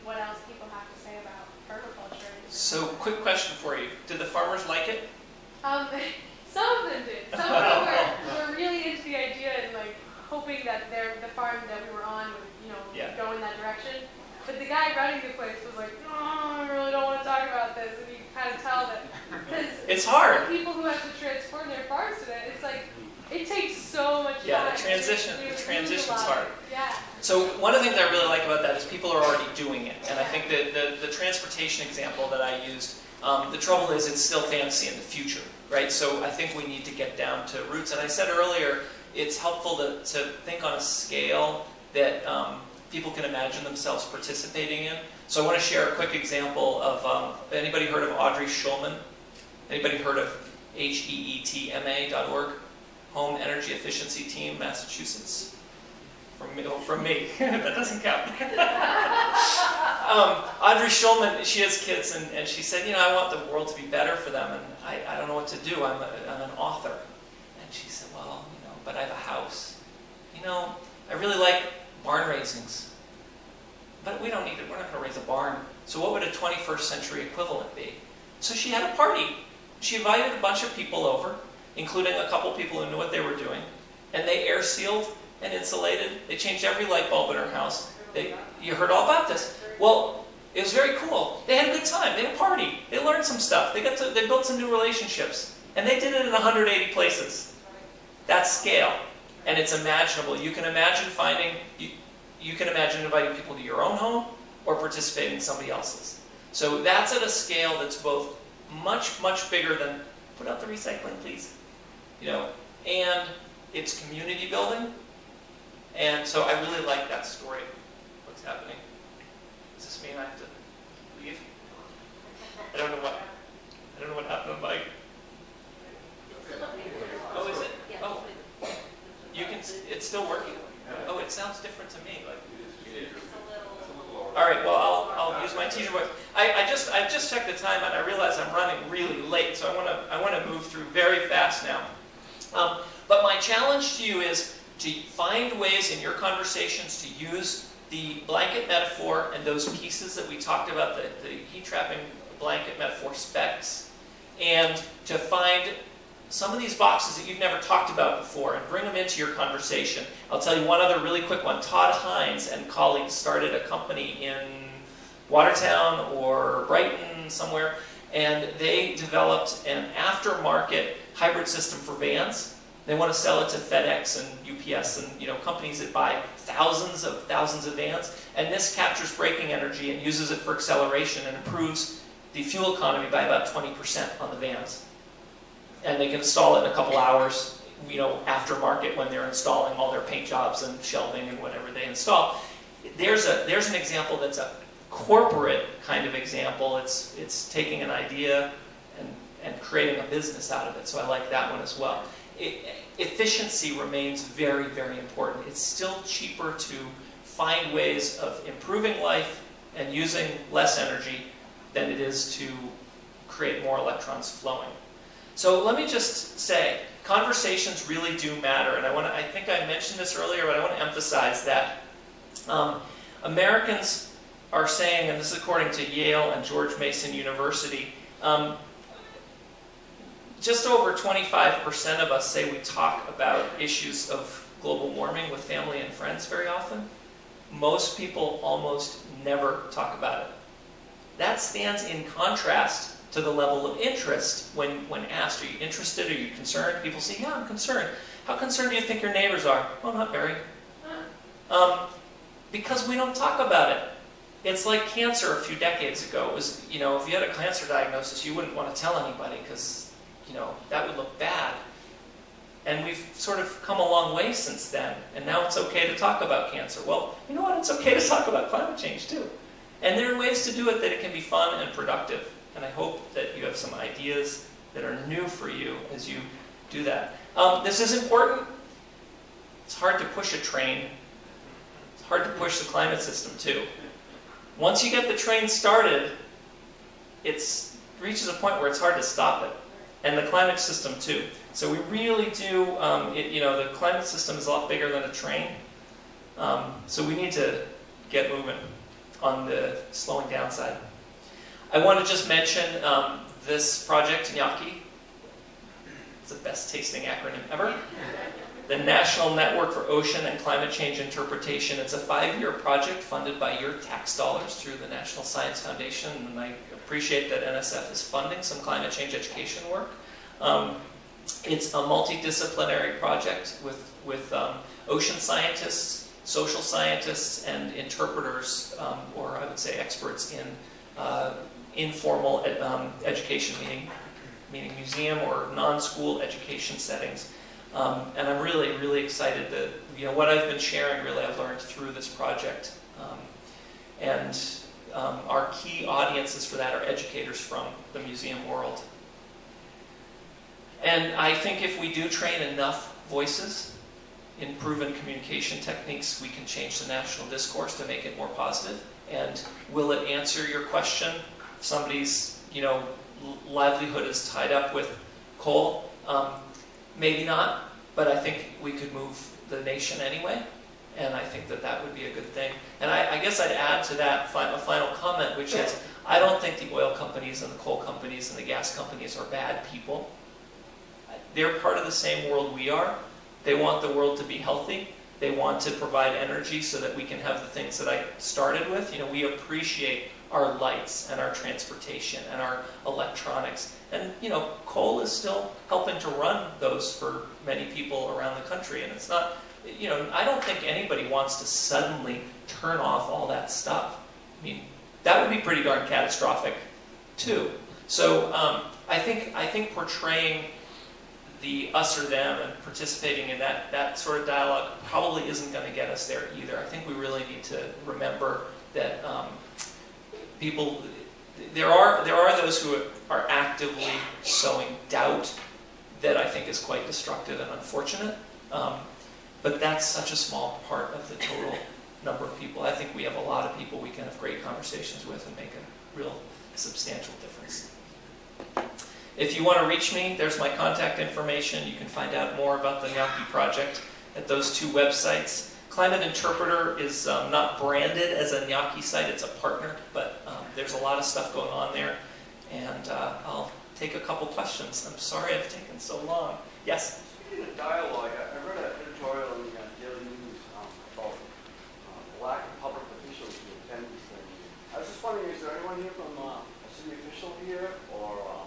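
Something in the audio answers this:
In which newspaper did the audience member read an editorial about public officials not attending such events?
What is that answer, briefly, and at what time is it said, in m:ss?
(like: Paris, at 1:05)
Daily News, at 7:39.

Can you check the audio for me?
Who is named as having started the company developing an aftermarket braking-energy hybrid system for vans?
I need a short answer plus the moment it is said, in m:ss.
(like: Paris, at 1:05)
Todd Hines, at 2:41.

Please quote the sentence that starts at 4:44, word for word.
Once you get the train started, it reaches a point where it's hard to stop it and the climate system too.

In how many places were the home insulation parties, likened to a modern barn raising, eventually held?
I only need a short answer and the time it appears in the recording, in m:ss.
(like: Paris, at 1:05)
180, at 1:36.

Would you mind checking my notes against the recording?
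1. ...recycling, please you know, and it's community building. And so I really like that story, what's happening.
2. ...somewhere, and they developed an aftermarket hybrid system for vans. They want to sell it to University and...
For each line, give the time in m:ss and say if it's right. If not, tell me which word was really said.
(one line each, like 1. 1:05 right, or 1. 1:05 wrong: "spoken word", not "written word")
1. 1:50 right
2. 2:47 wrong: "FedEx", not "University".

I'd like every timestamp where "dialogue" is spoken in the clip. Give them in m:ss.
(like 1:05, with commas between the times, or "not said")
6:54, 7:37.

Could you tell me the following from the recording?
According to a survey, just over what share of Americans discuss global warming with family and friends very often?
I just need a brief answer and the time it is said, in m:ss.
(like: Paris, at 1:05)
25%, at 3:50.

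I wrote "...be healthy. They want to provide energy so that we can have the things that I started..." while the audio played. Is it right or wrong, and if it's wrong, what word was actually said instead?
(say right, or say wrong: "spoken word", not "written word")
right.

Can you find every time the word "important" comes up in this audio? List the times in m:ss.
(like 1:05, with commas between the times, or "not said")
3:24, 4:38.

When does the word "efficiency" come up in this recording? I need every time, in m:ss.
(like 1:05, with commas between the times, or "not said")
0:53, 3:22.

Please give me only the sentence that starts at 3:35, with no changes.
So let me just say, conversations really do matter.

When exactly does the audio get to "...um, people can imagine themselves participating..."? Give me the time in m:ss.
0:42.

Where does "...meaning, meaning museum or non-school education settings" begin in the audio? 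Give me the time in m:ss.
5:33.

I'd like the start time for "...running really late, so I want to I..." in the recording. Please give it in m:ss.
2:18.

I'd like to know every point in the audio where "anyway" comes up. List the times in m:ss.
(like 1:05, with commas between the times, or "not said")
6:10.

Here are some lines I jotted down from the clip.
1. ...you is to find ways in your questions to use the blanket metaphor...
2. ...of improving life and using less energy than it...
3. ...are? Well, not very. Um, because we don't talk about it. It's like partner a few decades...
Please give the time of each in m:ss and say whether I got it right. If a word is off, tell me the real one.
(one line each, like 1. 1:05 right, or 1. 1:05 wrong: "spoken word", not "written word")
1. 2:24 wrong: "conversations", not "questions"
2. 3:28 right
3. 4:09 wrong: "cancer", not "partner".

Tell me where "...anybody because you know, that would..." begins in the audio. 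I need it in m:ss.
4:18.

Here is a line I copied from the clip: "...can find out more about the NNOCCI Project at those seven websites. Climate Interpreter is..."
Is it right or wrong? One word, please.
wrong.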